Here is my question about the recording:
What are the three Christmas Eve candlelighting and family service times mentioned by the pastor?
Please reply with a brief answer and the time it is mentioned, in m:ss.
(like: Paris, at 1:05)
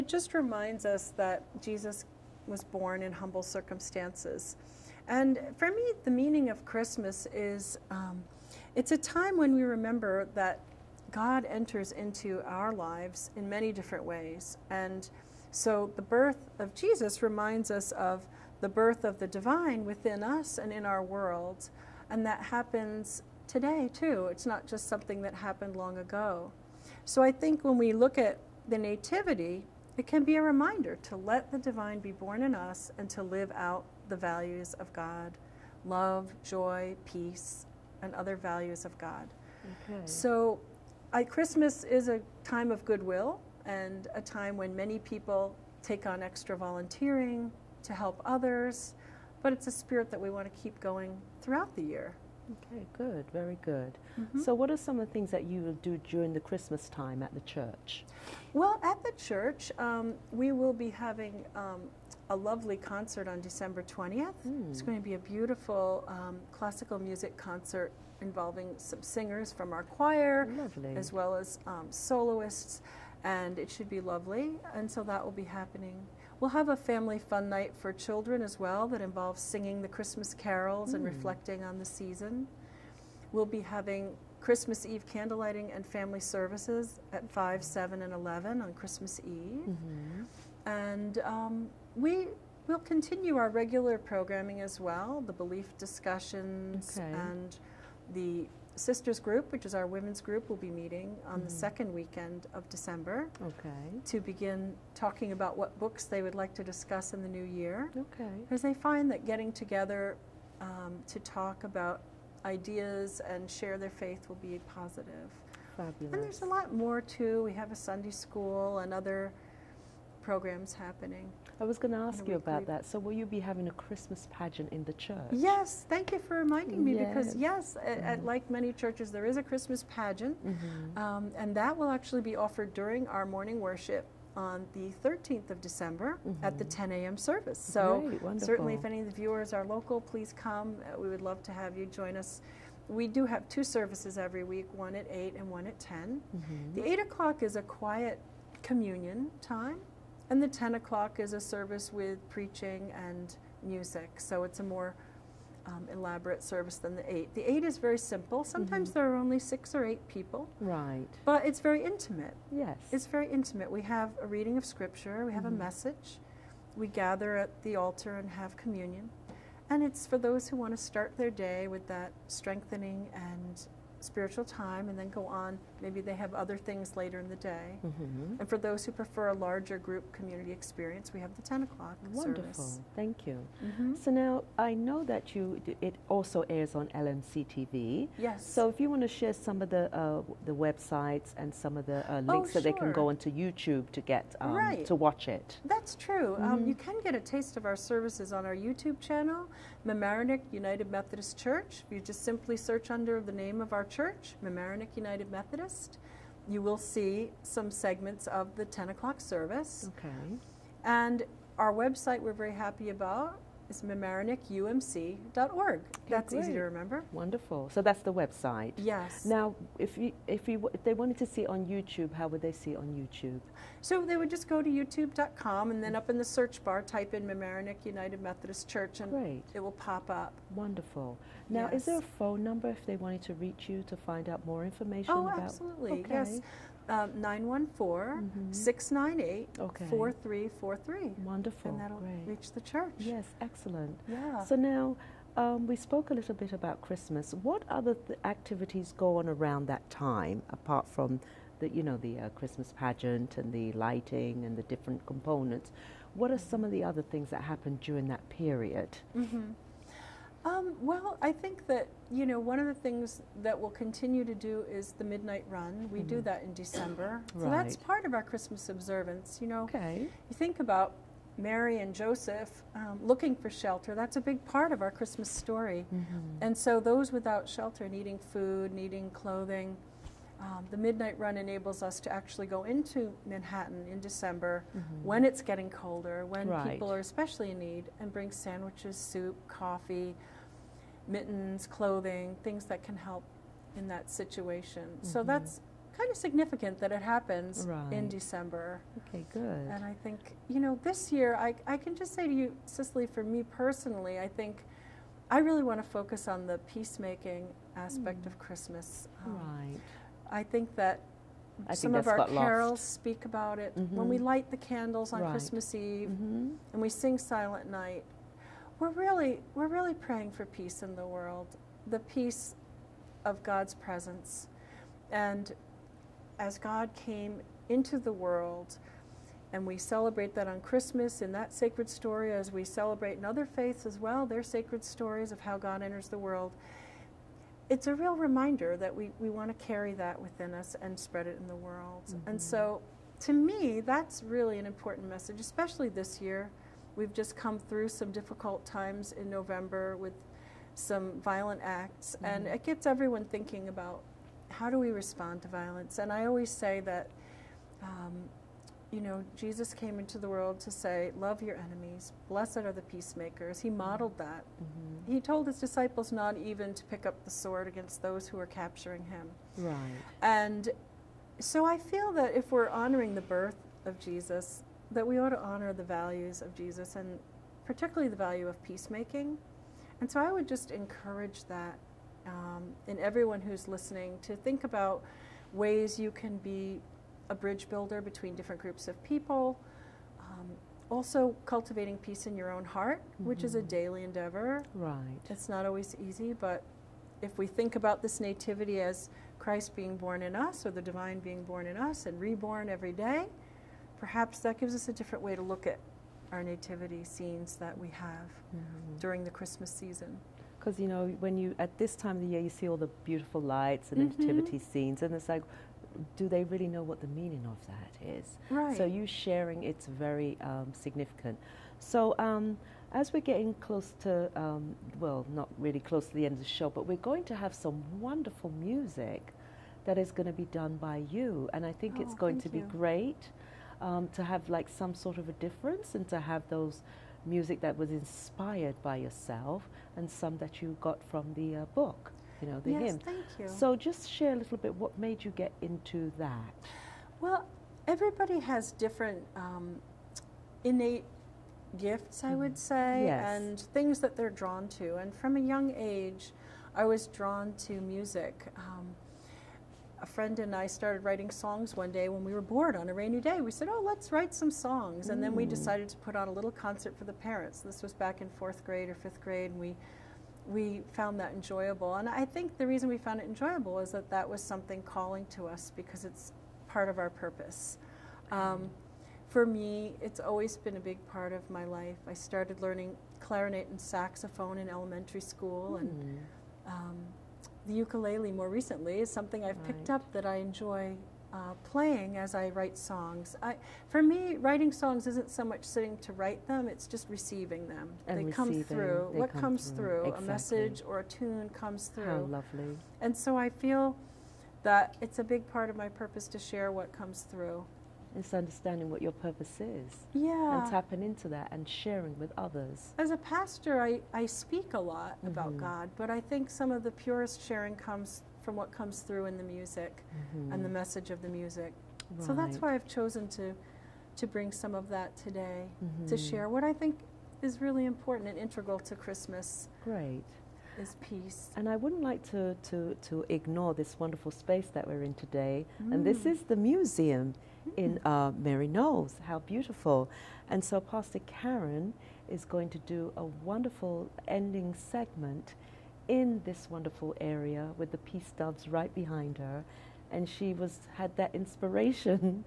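5, 7, and 11, at 1:27.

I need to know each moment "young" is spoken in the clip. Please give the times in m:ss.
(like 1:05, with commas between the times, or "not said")
7:35.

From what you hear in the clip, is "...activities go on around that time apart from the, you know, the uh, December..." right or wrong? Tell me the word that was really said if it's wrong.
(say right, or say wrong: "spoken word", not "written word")
wrong: "Christmas", not "December".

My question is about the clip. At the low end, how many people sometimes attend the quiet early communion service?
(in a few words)
6.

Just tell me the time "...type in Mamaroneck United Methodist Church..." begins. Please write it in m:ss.
3:46.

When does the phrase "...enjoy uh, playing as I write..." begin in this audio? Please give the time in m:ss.
8:10.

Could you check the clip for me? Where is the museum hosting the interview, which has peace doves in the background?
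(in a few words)
Maryknoll.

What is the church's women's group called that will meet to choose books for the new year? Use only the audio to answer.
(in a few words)
sisters group.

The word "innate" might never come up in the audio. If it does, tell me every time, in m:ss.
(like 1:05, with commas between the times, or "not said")
7:30.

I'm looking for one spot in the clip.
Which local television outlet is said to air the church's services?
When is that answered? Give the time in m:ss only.
3:07.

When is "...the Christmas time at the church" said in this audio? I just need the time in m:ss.
0:56.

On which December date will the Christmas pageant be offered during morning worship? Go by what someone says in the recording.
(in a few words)
13th.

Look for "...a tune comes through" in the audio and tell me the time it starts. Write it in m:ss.
8:21.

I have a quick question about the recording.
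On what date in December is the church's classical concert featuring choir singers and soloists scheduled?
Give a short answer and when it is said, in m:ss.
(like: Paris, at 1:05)
December 20, at 1:03.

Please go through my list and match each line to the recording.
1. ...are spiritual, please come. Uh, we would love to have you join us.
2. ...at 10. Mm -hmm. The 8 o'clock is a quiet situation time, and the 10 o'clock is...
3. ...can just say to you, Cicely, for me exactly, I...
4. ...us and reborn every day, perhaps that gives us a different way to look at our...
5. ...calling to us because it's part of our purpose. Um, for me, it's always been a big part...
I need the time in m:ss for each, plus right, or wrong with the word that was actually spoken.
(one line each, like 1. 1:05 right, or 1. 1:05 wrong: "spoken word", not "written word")
1. 2:19 wrong: "local", not "spiritual"
2. 2:25 wrong: "communion", not "situation"
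3. 5:01 wrong: "personally", not "exactly"
4. 6:41 right
5. 7:54 right.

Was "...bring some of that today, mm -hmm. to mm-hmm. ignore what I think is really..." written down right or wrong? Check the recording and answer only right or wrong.
wrong.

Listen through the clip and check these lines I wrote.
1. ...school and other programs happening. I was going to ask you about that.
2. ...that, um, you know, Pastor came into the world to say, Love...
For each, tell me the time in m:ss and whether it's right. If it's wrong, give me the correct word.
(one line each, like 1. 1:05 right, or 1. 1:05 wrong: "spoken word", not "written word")
1. 1:58 right
2. 5:56 wrong: "Jesus", not "Pastor".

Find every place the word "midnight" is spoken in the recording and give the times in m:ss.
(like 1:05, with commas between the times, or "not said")
4:25, 4:40.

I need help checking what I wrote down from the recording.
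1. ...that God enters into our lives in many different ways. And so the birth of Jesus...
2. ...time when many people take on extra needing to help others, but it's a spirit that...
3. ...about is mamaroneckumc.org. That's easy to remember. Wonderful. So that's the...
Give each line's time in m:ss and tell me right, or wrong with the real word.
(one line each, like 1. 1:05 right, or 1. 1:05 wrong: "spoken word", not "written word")
1. 0:10 right
2. 0:44 wrong: "volunteering", not "needing"
3. 3:32 right.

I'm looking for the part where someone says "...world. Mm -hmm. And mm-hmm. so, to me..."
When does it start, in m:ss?
5:41.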